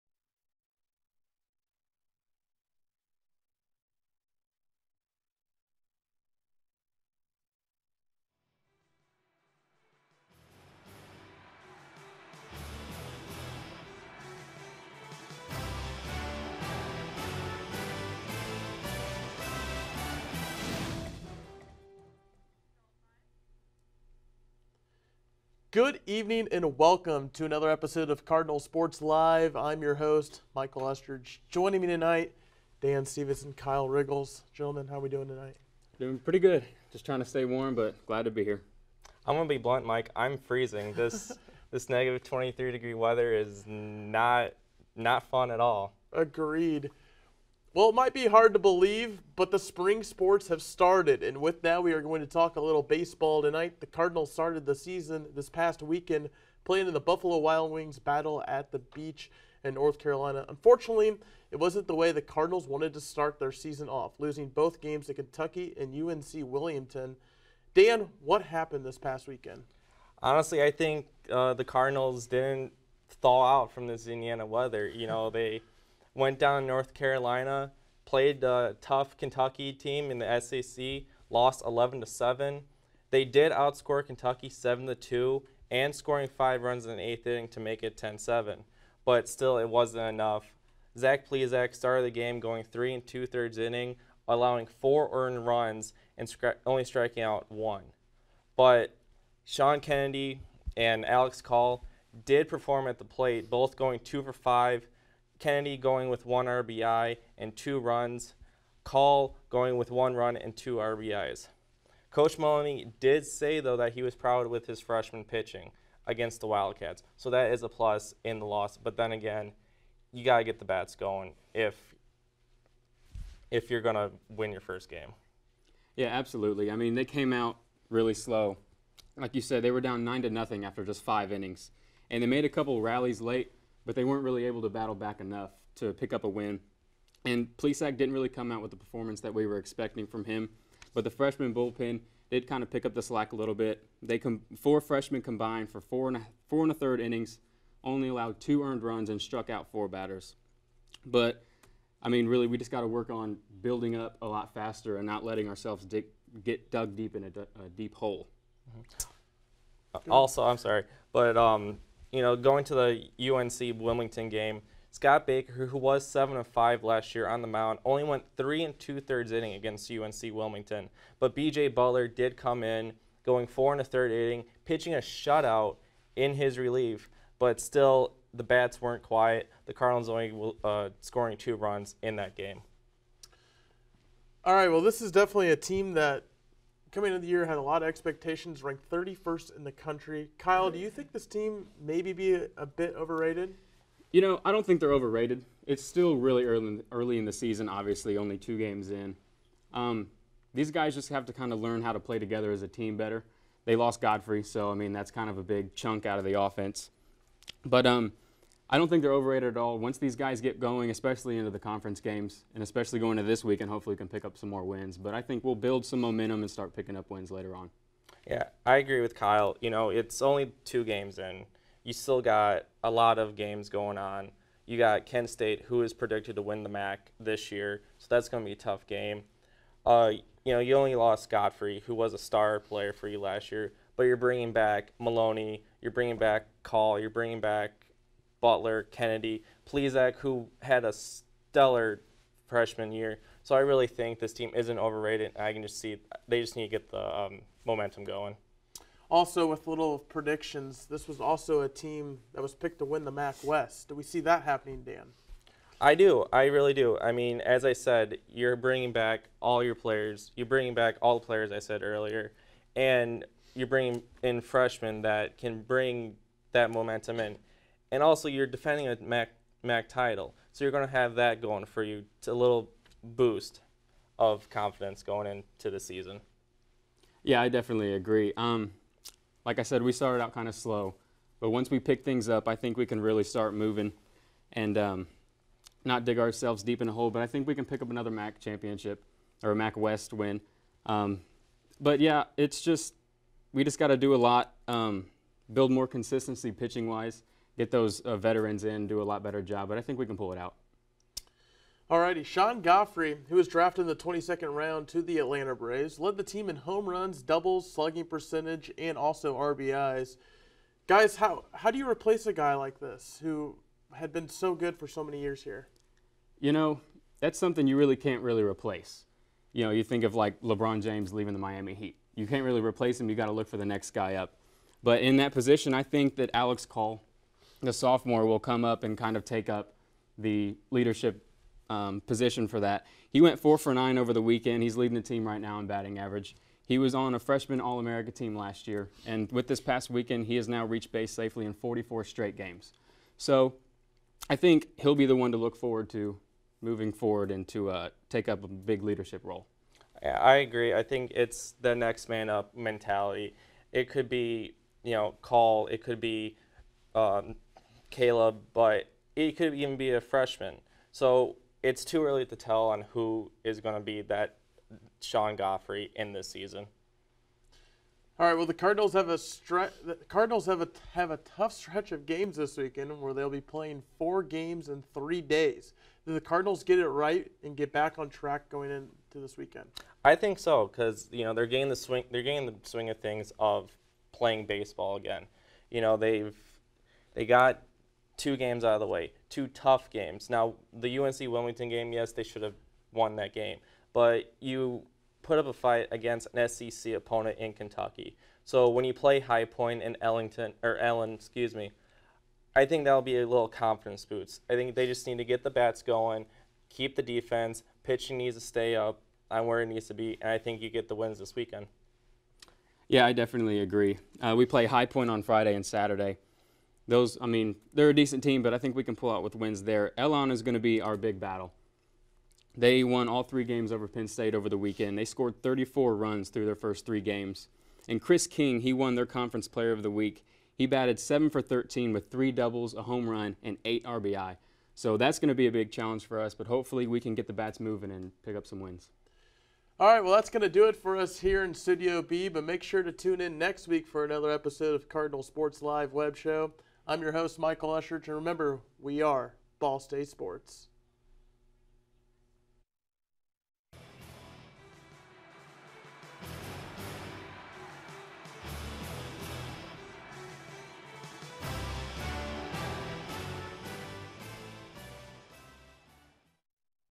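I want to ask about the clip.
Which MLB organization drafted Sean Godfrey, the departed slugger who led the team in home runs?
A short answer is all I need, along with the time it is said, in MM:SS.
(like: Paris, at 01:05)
Atlanta Braves, at 05:05.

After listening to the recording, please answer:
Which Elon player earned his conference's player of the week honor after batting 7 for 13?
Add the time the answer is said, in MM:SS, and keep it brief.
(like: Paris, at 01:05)
Chris King, at 07:08.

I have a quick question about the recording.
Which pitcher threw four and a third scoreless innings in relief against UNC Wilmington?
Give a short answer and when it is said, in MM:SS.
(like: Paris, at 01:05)
BJ Butler, at 02:51.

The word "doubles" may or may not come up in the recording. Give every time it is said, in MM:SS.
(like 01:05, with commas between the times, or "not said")
05:07, 07:12.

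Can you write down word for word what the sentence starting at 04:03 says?
So I really think this team isn't overrated.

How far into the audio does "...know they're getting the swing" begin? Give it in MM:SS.
06:21.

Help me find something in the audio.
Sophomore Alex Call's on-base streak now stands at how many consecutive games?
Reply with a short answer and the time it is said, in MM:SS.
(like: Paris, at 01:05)
44, at 05:41.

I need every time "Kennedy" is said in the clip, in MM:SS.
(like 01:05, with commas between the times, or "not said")
01:39, 01:45, 03:58.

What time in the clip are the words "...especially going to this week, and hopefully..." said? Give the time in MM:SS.
03:32.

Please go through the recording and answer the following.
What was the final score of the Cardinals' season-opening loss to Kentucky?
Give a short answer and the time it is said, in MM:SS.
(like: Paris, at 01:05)
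11 to 7, at 01:21.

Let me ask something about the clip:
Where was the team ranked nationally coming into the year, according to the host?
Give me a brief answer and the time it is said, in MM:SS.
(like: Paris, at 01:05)
31st, at 03:08.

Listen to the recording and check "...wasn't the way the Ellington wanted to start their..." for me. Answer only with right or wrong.
wrong.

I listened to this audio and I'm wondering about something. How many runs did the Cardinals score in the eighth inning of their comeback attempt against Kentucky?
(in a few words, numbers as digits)
5.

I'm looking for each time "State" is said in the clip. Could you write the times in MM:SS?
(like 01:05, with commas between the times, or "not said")
03:45, 07:04, 07:29.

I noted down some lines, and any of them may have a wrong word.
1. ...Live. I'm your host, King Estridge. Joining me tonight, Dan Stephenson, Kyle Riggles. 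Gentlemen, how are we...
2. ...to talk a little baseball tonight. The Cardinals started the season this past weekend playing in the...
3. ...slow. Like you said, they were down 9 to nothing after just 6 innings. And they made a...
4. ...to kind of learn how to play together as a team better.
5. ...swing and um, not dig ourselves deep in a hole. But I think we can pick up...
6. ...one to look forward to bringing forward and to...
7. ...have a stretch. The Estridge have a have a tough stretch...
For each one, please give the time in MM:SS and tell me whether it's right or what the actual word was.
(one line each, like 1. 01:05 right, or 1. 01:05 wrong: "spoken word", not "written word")
1. 00:29 wrong: "Michael", not "King"
2. 00:52 right
3. 02:08 wrong: "5", not "6"
4. 03:21 right
5. 04:43 wrong: "moving", not "swing"
6. 05:45 wrong: "moving", not "bringing"
7. 06:08 wrong: "Cardinals", not "Estridge".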